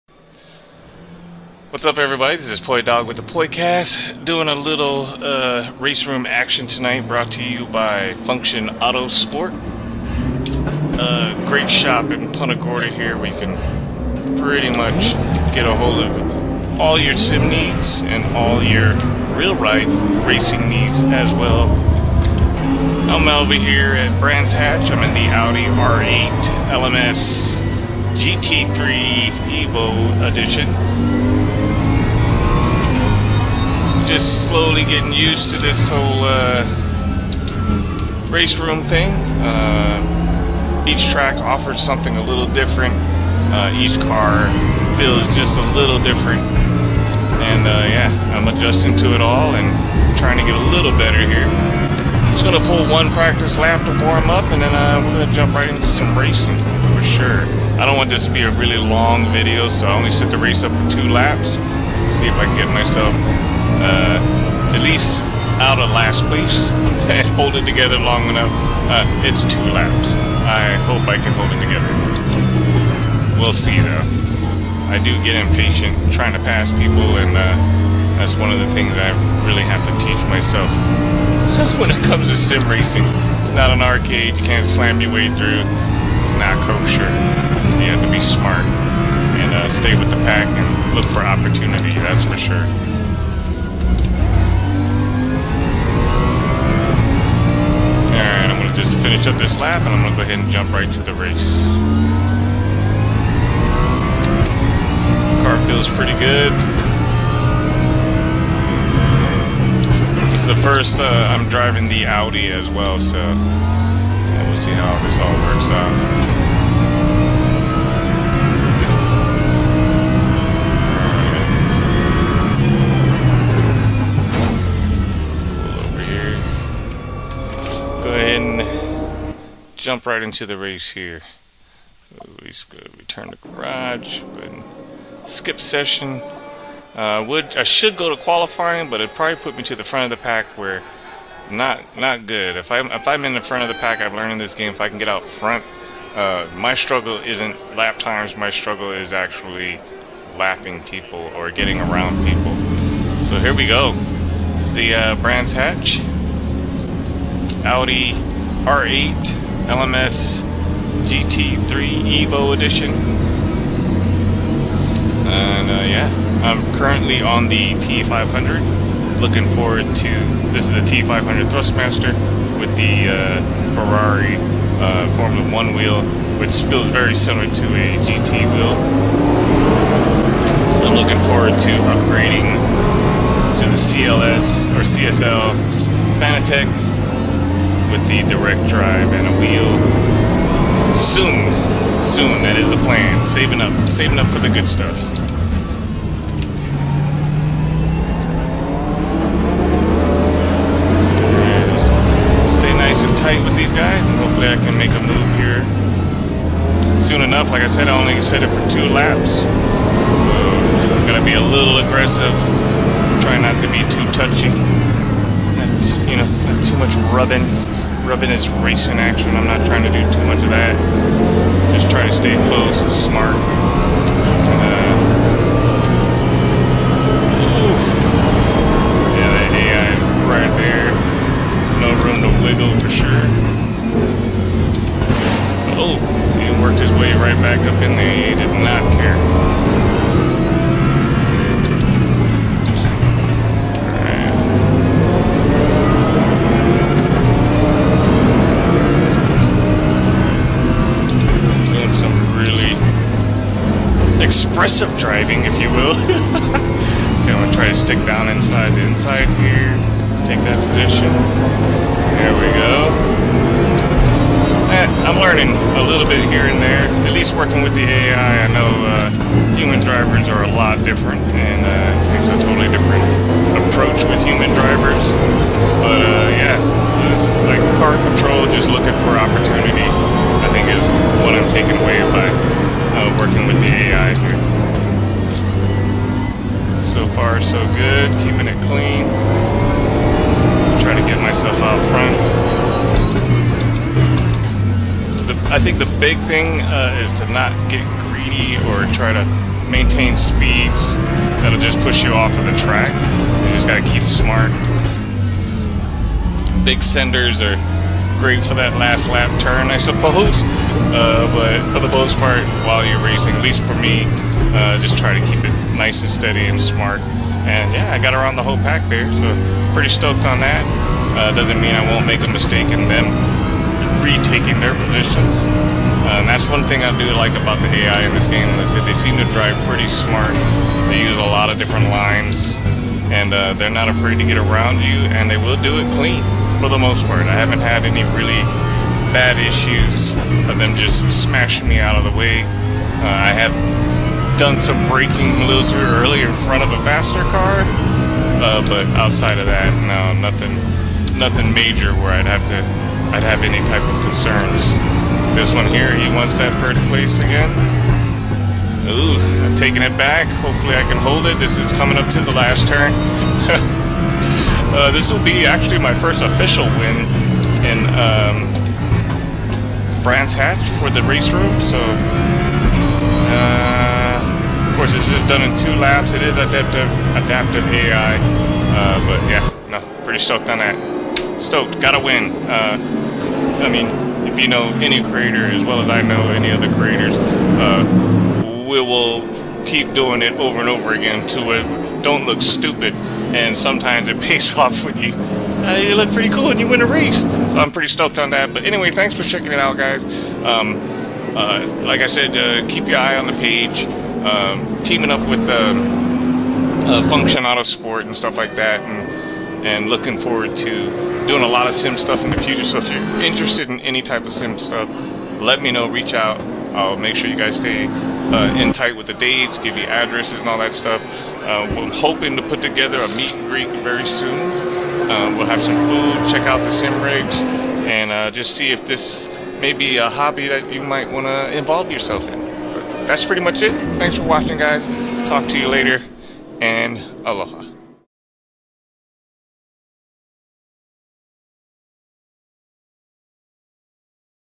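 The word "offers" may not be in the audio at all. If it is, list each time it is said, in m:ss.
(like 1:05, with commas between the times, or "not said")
0:41.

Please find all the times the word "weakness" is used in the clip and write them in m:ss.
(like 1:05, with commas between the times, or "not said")
not said.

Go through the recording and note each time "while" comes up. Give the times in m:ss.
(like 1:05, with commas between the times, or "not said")
5:12.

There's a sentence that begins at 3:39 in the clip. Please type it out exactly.
I'm not trying to do too much of that.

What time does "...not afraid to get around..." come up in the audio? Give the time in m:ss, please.
5:33.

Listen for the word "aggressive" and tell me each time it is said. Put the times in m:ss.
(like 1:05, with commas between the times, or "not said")
3:31, 4:14.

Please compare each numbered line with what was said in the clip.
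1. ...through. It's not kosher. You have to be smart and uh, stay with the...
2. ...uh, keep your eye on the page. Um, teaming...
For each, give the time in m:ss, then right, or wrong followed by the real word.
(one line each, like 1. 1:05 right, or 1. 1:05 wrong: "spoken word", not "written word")
1. 1:25 right
2. 6:42 right.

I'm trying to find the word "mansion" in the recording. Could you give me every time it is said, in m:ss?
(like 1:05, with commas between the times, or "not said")
not said.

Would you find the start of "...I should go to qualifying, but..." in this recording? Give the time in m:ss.
2:17.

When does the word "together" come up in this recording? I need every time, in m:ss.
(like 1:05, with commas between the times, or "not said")
1:07, 1:11, 7:02.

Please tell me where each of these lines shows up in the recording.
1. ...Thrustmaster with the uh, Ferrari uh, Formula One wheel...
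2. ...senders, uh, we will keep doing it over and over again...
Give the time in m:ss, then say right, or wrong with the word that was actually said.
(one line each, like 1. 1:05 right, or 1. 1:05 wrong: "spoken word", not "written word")
1. 2:51 right
2. 6:26 wrong: "creators", not "senders".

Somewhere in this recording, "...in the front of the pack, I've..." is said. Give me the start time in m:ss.
2:23.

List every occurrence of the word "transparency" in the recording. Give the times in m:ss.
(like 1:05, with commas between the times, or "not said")
not said.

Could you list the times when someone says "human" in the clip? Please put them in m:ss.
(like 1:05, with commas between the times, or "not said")
4:29, 4:34.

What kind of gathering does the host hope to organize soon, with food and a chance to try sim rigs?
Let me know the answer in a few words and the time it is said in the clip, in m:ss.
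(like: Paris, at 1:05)
meet and greet, at 7:03.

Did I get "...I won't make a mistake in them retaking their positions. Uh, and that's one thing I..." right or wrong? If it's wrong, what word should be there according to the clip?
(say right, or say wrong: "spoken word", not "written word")
right.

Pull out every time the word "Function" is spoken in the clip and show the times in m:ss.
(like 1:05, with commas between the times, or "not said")
0:08, 6:47.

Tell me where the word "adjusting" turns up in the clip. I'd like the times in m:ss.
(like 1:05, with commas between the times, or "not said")
0:48.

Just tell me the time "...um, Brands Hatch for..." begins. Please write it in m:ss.
6:07.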